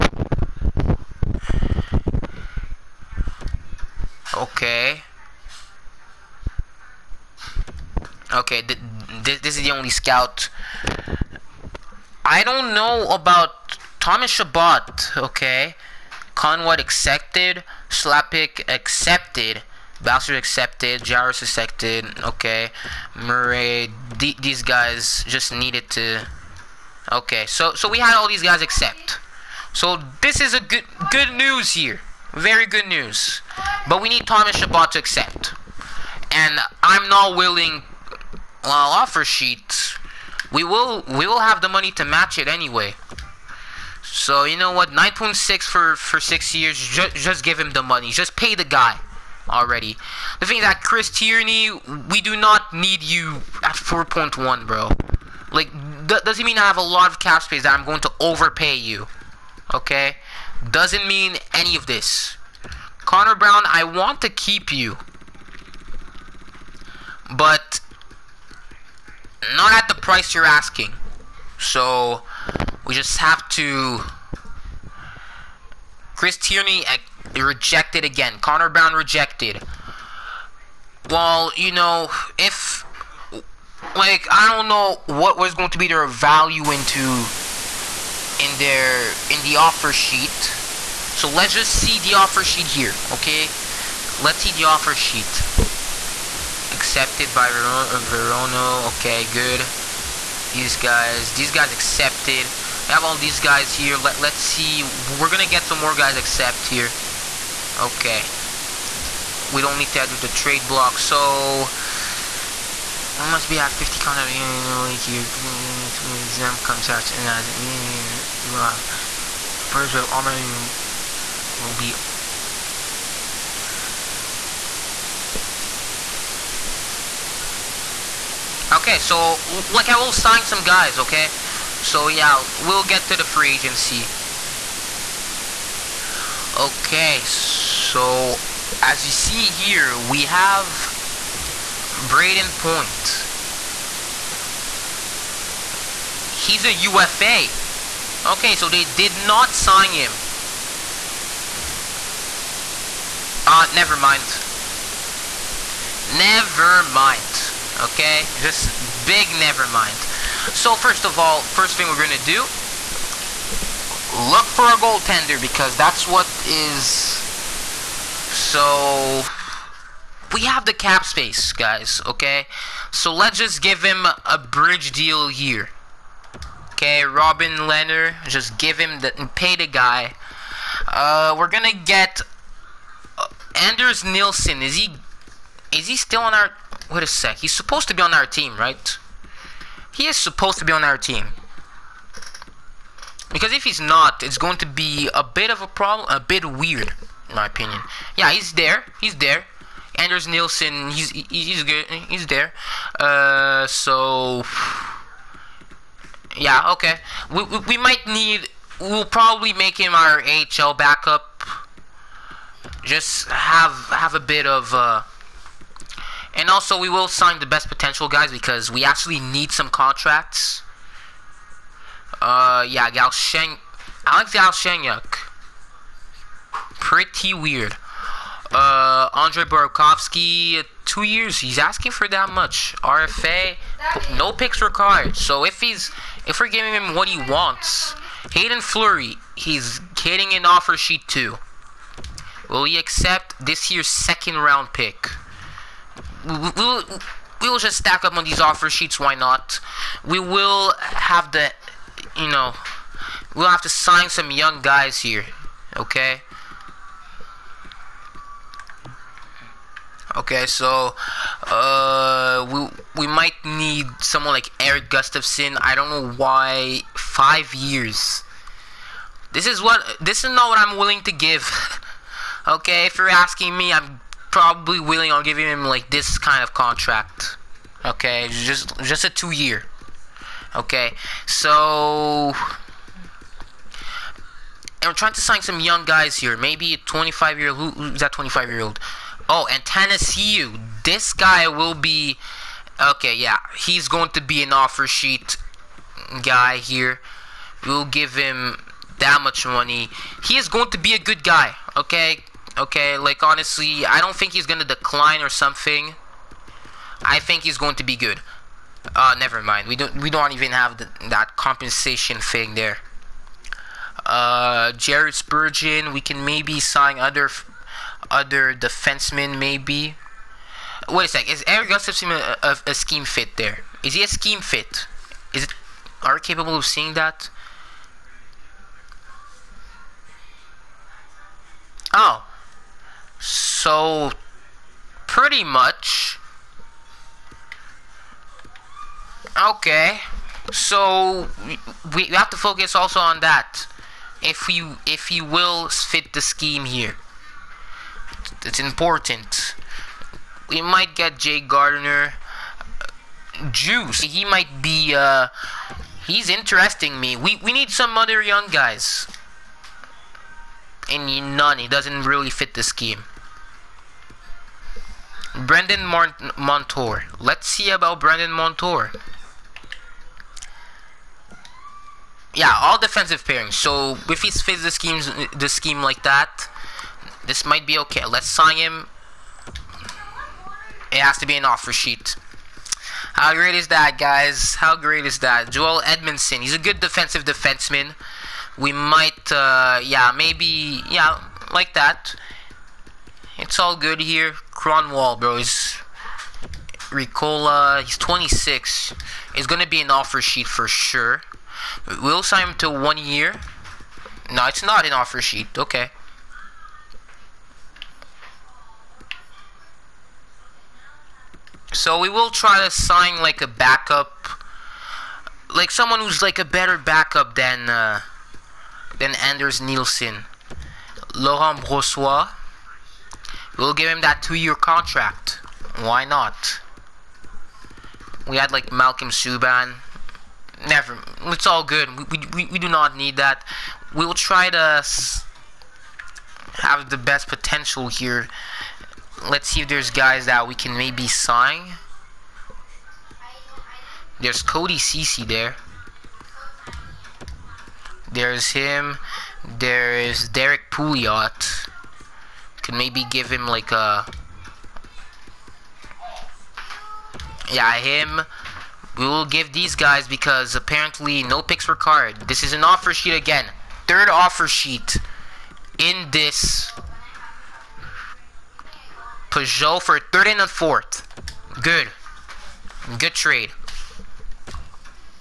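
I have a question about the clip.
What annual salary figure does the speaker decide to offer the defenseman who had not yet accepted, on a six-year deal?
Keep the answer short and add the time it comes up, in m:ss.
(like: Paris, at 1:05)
9.6, at 0:44.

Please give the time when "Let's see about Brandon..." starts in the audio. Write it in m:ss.
6:07.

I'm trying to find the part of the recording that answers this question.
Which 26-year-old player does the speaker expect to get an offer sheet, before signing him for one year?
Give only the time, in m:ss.
6:36.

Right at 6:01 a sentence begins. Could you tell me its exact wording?
He doesn't really fit the scheme.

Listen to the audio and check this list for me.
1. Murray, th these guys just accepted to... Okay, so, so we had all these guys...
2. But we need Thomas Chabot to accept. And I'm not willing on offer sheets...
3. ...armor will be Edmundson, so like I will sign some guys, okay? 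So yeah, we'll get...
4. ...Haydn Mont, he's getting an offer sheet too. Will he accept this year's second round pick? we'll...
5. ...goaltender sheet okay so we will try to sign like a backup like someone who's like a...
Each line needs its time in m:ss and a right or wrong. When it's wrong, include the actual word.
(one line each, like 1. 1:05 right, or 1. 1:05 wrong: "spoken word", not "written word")
1. 0:23 wrong: "needed", not "accepted"
2. 0:33 right
3. 2:00 wrong: "Okay", not "Edmundson"
4. 3:58 wrong: "Fleury", not "Mont"
5. 6:44 wrong: "offer", not "goaltender".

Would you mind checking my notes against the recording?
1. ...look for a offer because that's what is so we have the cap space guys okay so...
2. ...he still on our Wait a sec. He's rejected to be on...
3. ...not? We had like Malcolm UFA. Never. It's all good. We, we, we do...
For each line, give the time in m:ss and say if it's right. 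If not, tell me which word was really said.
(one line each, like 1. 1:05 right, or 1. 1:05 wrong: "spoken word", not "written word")
1. 2:44 wrong: "goaltender", not "offer"
2. 3:05 wrong: "supposed", not "rejected"
3. 7:06 wrong: "Subban", not "UFA".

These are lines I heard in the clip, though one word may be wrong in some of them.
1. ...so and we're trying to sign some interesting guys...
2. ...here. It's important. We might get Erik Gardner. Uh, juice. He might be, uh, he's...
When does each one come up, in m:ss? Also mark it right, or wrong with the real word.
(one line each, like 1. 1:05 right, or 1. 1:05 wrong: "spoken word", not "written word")
1. 4:41 wrong: "young", not "interesting"
2. 5:46 wrong: "Jay", not "Erik".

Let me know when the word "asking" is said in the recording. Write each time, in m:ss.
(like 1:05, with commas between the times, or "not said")
1:10, 3:51, 4:33.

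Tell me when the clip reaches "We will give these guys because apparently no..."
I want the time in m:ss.
7:38.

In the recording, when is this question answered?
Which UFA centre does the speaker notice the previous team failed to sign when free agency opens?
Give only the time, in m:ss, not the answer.
2:22.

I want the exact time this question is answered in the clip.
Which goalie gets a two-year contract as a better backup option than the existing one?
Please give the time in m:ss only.
7:01.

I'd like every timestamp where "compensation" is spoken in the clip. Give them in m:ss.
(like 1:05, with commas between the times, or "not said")
5:11.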